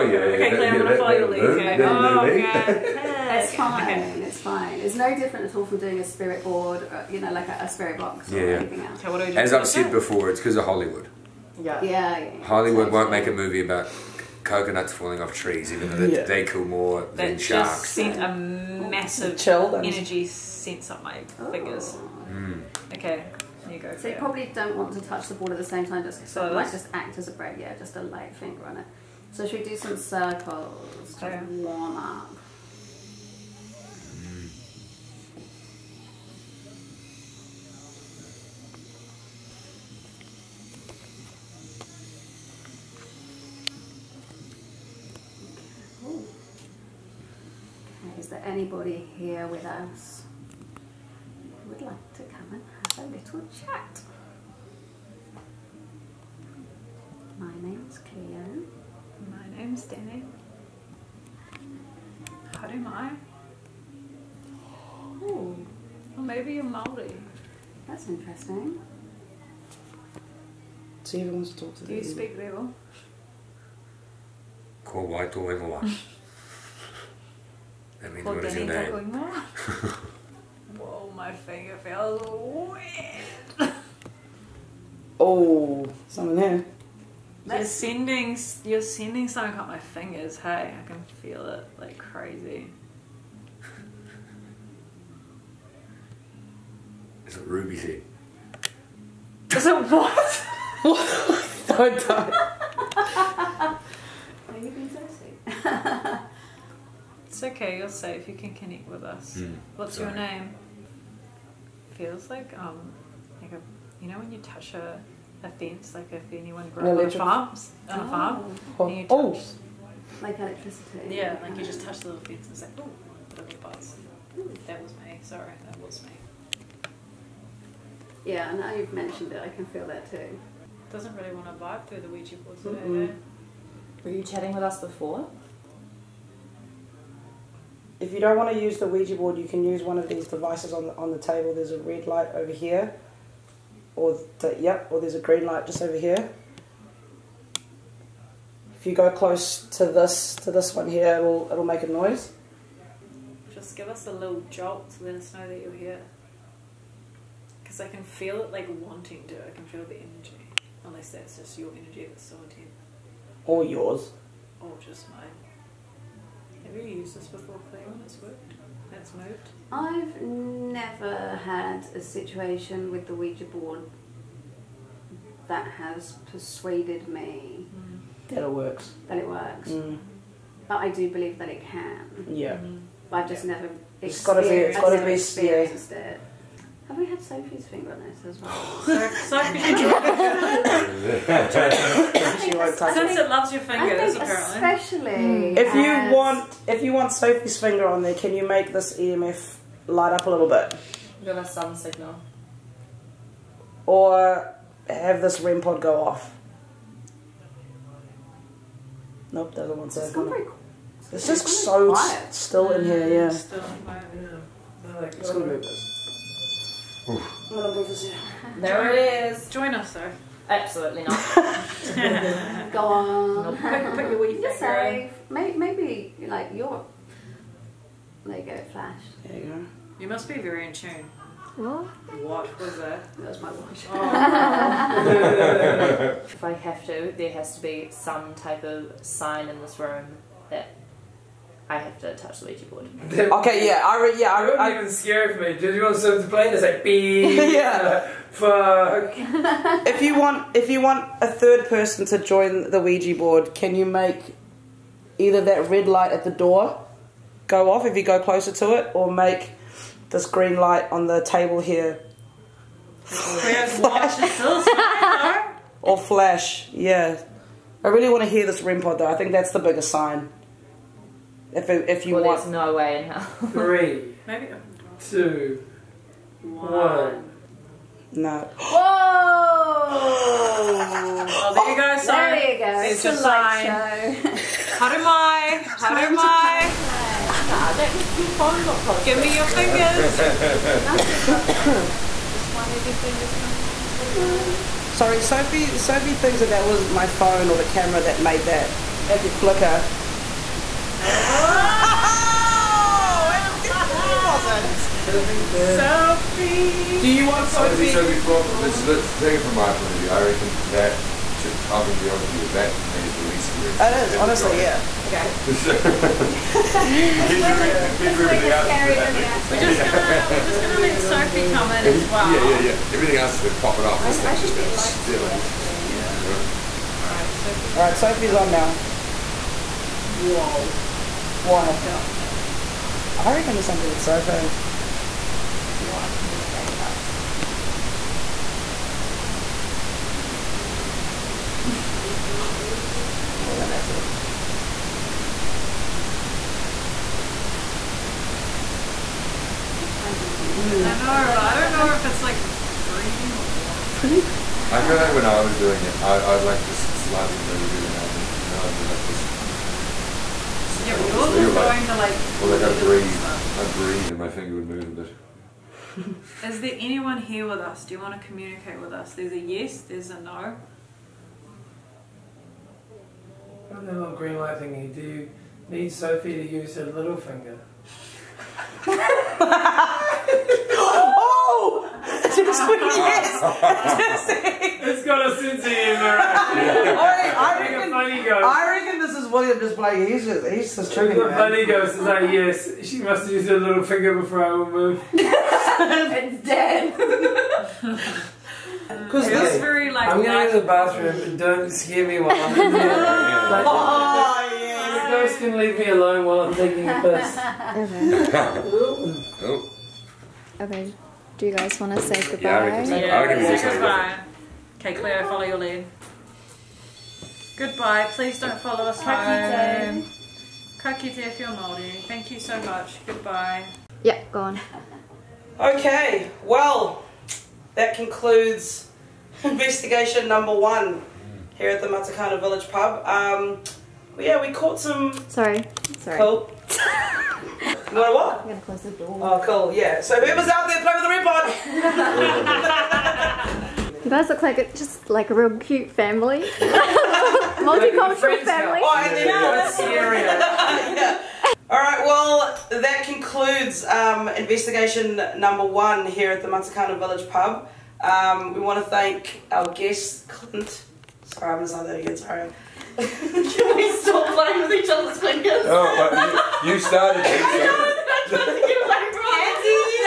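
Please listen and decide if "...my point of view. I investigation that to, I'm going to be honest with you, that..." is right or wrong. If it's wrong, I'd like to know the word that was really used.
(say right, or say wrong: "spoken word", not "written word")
wrong: "reckon", not "investigation".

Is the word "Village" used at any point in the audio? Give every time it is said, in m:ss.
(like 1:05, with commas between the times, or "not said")
7:12, 7:36.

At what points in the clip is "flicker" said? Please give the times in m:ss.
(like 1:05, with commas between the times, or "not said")
4:59.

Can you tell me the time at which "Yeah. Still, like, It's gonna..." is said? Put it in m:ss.
3:33.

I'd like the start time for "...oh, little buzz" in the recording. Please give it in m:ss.
2:02.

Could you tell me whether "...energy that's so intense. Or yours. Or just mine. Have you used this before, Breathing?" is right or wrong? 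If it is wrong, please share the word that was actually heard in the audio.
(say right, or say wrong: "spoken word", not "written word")
wrong: "Cleo", not "Breathing".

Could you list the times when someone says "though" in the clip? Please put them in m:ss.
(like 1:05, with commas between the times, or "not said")
0:15, 3:39, 4:28.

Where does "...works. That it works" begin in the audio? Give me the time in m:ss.
2:58.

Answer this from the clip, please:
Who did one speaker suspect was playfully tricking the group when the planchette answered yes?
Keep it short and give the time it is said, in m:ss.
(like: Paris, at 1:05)
William, at 6:29.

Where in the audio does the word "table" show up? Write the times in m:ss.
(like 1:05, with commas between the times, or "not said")
2:21, 4:21.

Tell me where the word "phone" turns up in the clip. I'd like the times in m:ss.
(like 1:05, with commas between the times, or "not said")
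4:48, 4:57.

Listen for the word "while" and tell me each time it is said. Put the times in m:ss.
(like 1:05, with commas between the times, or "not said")
6:42, 6:46.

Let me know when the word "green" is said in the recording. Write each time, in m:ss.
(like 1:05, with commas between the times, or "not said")
2:25, 4:20, 6:14.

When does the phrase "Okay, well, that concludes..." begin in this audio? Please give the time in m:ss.
7:05.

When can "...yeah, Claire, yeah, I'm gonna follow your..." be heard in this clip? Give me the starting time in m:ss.
0:00.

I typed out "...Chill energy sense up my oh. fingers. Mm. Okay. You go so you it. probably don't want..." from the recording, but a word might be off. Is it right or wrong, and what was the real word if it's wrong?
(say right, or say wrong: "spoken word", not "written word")
right.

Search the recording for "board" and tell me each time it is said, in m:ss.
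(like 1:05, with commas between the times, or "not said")
0:06, 2:12, 2:19, 2:53, 4:02, 4:13.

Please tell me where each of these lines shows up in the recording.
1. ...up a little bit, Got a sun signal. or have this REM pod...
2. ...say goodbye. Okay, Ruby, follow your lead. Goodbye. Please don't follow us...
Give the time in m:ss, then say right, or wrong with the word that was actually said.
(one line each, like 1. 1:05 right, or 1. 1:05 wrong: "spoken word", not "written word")
1. 3:20 right
2. 6:53 wrong: "Cleo", not "Ruby".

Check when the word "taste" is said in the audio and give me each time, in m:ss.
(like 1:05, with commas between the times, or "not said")
not said.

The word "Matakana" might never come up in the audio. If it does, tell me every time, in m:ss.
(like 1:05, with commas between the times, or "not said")
7:11, 7:36.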